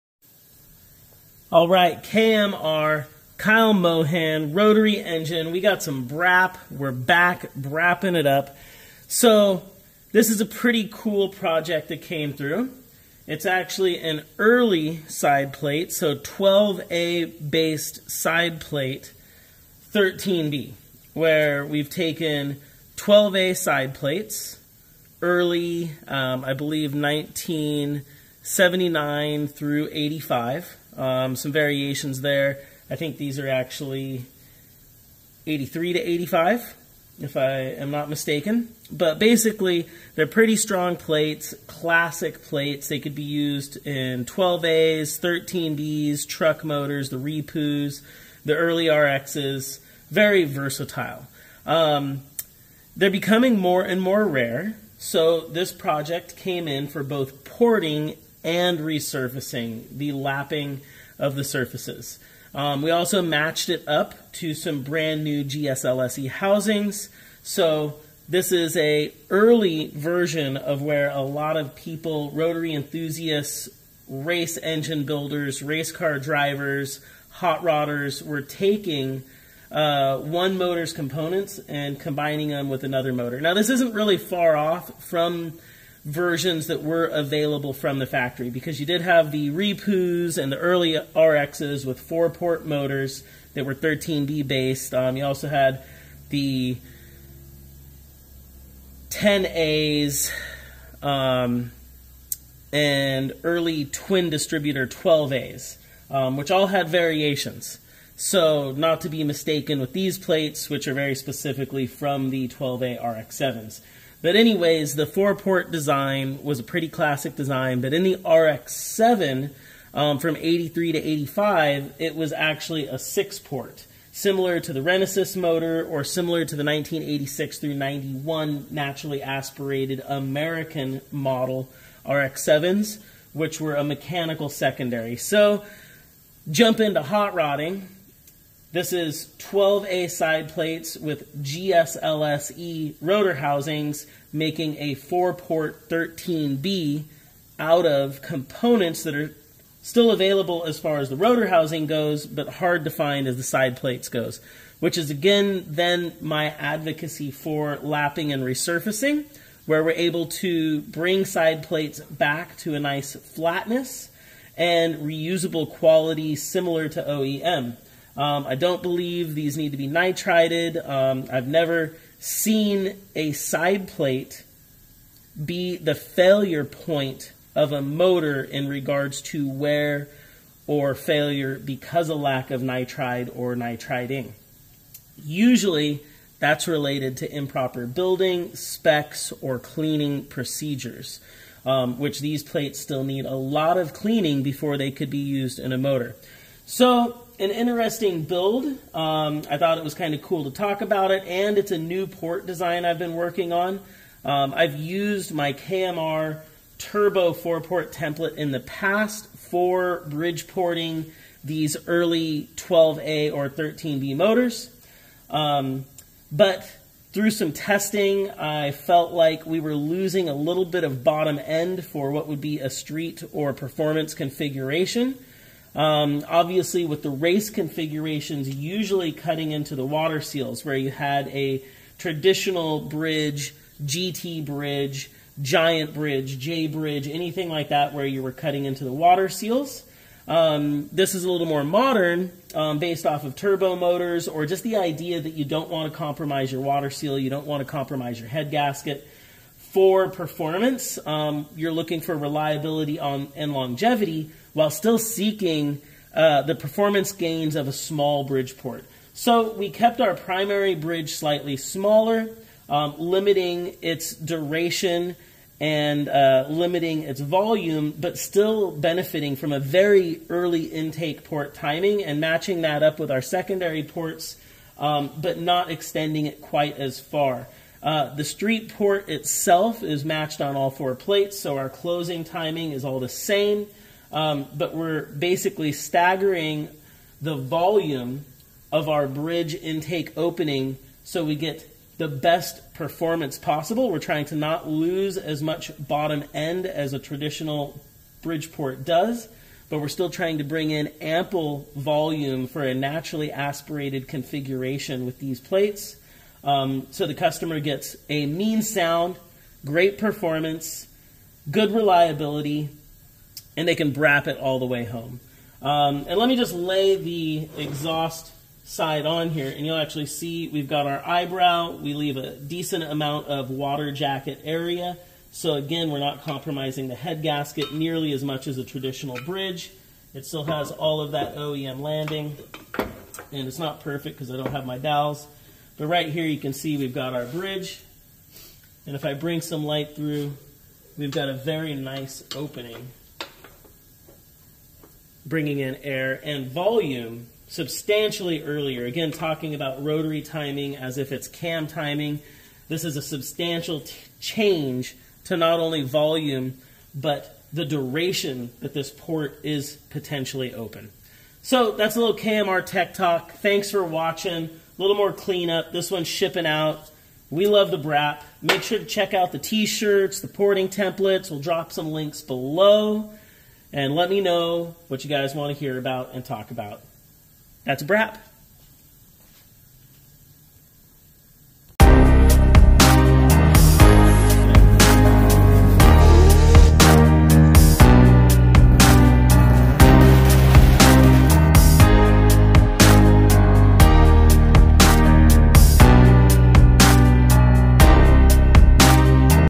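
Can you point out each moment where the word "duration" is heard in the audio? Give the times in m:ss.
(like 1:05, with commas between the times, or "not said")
4:24, 5:57.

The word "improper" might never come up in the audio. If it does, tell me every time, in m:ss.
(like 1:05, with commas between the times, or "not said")
3:07.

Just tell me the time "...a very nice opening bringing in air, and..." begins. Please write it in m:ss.
5:41.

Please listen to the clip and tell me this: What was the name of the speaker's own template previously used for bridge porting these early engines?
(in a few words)
KMR Turbo four port template.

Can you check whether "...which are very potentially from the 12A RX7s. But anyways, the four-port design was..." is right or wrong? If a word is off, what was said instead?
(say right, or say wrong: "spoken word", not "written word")
wrong: "specifically", not "potentially".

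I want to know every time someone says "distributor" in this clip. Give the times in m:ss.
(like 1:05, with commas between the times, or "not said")
1:44.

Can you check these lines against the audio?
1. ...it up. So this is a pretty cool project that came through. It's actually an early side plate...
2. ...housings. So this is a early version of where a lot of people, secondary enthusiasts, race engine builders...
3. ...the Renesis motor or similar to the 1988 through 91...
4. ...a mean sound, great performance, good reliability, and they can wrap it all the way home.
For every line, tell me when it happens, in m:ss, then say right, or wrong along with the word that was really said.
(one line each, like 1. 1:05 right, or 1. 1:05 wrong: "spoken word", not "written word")
1. 0:08 right
2. 1:06 wrong: "rotary", not "secondary"
3. 2:04 wrong: "1986", not "1988"
4. 5:08 right.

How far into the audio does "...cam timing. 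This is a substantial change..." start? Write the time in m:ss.
5:51.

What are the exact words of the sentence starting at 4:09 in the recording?
For performance, um, you're looking for reliability on and longevity while still seeking uh, the performance gains of a small bridge port.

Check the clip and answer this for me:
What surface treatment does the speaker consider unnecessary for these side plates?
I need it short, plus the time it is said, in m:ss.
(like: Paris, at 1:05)
nitrided, at 2:49.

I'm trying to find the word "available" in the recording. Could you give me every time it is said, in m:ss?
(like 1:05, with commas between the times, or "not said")
1:27, 2:30.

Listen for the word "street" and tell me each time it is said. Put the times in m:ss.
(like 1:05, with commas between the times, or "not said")
3:42, 4:38.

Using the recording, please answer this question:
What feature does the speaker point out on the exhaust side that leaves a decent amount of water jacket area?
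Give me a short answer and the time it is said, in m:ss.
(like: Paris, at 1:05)
eyebrow, at 5:21.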